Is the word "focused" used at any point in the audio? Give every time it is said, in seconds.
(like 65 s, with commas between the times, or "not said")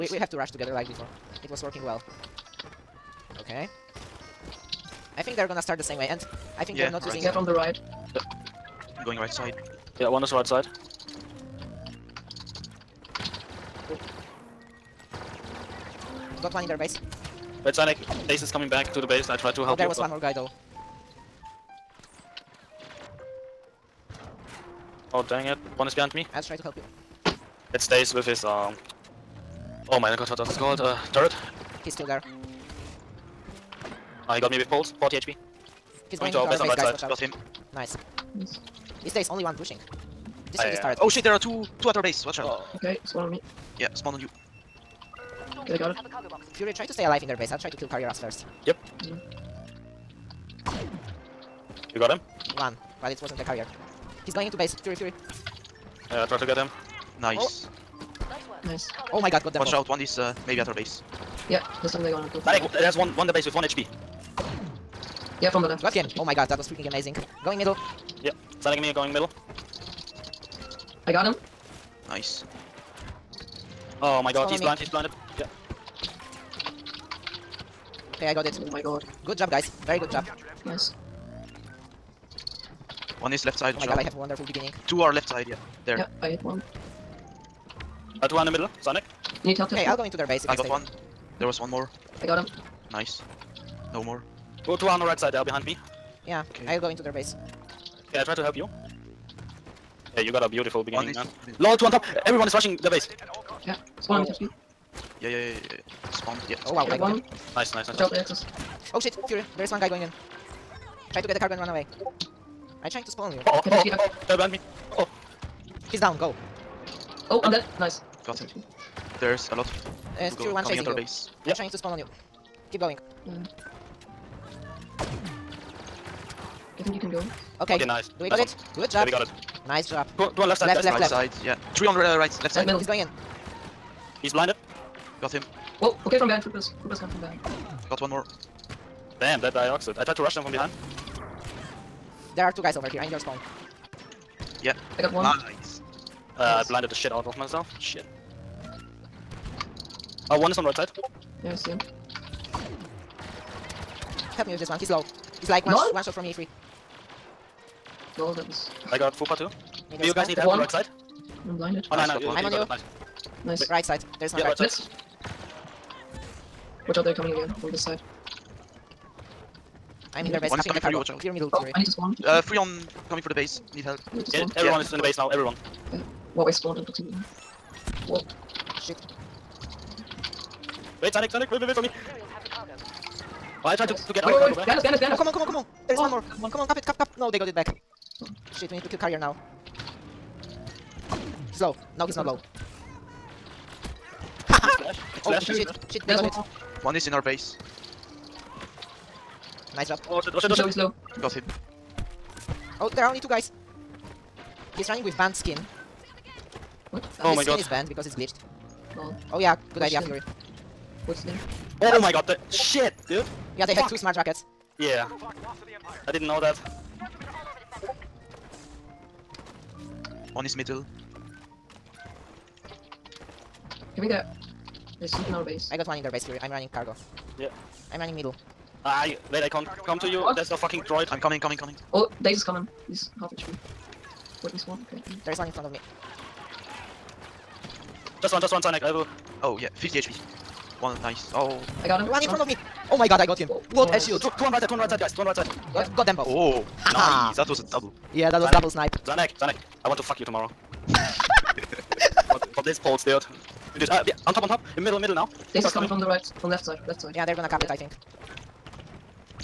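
not said.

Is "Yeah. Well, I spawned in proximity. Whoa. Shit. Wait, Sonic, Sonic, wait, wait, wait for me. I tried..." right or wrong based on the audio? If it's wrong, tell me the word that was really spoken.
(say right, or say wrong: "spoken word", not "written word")
right.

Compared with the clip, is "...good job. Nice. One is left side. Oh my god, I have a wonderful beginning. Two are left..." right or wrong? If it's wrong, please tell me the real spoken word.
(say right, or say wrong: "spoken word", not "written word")
right.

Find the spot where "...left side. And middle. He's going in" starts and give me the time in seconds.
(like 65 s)
132 s.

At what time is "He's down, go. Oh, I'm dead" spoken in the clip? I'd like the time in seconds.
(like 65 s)
115 s.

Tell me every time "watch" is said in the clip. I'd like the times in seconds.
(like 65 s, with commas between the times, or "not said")
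36 s, 42 s, 59 s, 107 s, 166 s, 170 s.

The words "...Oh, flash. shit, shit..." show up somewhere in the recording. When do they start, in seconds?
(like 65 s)
195 s.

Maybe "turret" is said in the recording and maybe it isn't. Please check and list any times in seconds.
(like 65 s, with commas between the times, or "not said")
31 s, 40 s.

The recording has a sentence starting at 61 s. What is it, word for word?
Yeah, this time they're gonna go.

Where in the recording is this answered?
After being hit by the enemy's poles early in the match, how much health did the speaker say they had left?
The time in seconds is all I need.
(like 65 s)
35 s.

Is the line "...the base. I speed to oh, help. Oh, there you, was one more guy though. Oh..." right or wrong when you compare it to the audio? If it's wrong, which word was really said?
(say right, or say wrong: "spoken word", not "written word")
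wrong: "tried", not "speed".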